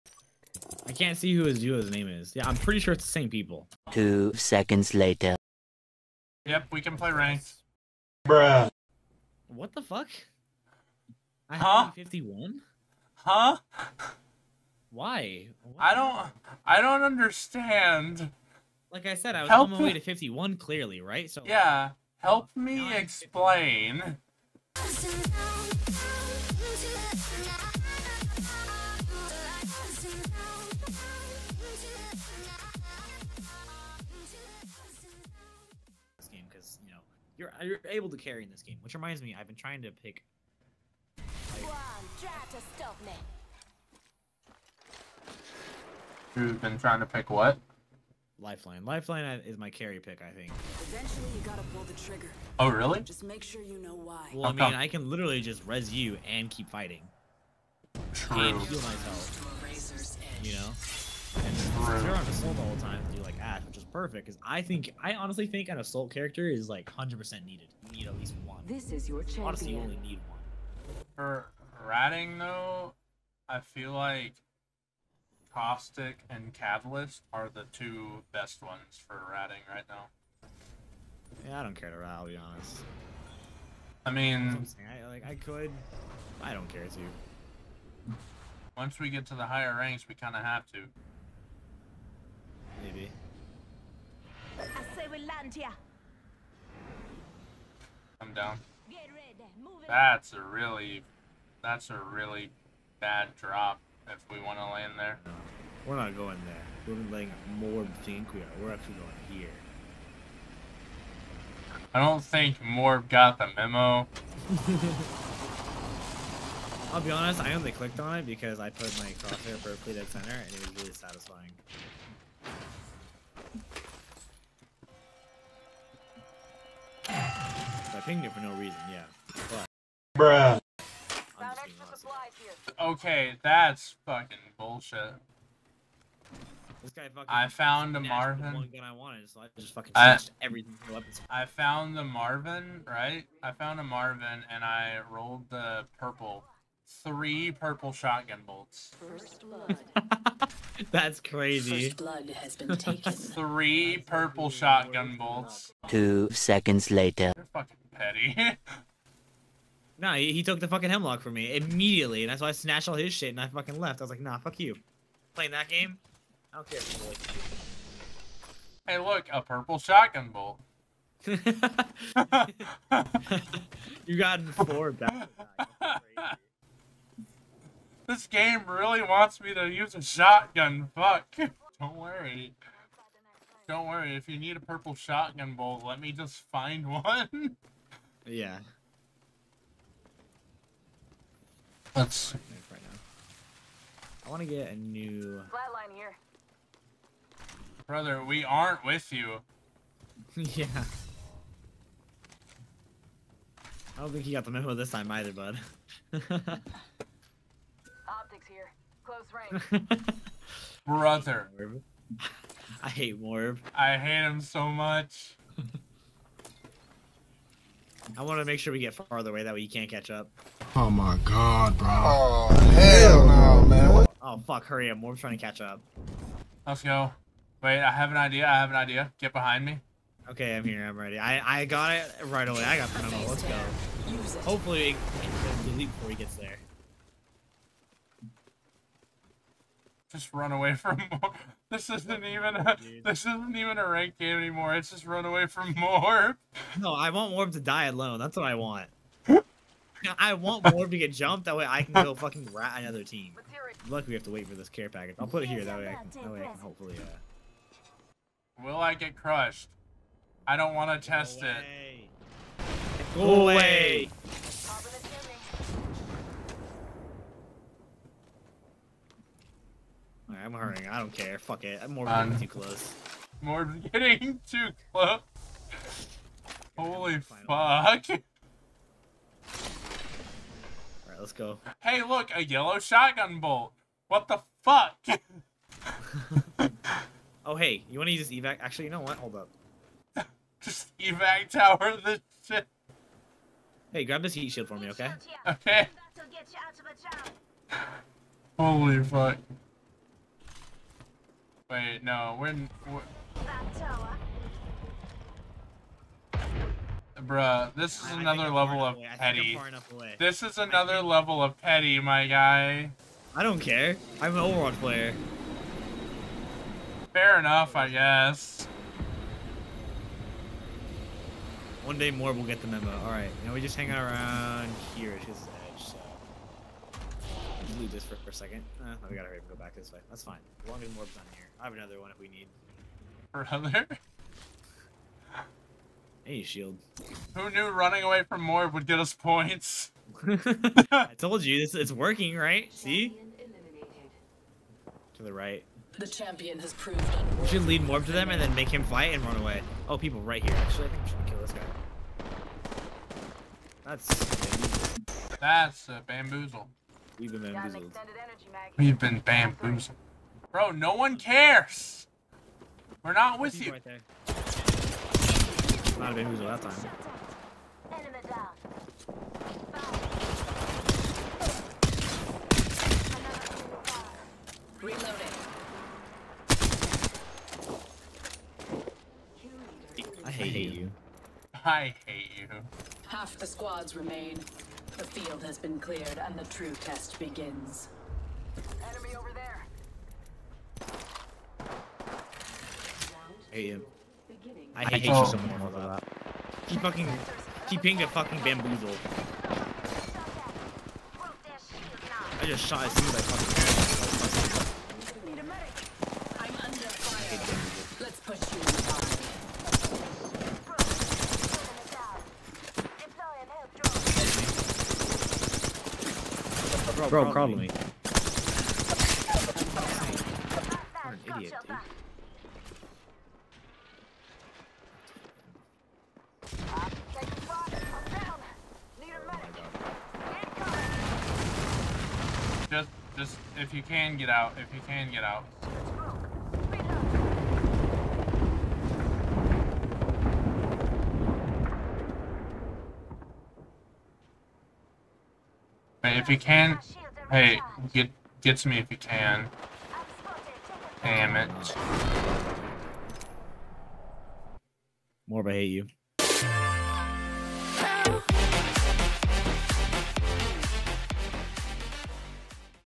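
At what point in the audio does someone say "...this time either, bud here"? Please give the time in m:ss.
3:24.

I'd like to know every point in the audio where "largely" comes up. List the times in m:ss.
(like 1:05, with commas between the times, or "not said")
not said.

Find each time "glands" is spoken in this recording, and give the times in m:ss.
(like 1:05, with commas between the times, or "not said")
not said.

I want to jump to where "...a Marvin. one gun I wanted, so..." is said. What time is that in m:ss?
2:17.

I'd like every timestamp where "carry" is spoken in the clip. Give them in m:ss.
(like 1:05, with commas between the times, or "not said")
0:38, 0:49.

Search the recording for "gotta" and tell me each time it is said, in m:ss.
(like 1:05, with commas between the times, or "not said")
0:51, 5:29.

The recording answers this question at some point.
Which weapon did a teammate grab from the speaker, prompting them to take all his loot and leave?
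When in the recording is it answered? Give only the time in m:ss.
2:40.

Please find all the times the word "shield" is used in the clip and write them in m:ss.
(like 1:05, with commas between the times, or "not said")
4:54, 5:36.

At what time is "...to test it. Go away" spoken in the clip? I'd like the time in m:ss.
4:21.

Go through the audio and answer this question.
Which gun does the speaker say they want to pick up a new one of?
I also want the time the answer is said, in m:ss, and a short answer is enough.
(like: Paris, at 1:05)
Flatline, at 3:15.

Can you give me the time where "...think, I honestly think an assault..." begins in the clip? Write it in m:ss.
1:04.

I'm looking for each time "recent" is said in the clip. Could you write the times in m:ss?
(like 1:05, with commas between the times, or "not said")
not said.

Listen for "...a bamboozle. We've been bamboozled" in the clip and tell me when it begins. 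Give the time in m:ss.
5:55.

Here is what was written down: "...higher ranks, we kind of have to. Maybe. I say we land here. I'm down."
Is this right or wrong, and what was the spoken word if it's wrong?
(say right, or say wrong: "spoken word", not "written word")
right.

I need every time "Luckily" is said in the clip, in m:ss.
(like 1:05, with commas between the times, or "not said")
4:13.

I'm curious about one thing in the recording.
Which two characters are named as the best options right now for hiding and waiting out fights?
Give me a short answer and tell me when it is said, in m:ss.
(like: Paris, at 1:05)
Caustic and Catalyst, at 1:15.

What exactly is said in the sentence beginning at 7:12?
Just, just, if you can get out, if you can get out.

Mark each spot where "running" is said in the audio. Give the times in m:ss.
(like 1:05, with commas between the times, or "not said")
5:37.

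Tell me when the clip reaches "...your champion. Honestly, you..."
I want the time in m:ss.
1:09.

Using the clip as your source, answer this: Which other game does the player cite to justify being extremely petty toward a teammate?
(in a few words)
Overwatch.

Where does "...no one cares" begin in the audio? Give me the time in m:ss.
6:00.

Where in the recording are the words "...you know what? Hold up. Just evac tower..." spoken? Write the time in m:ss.
4:48.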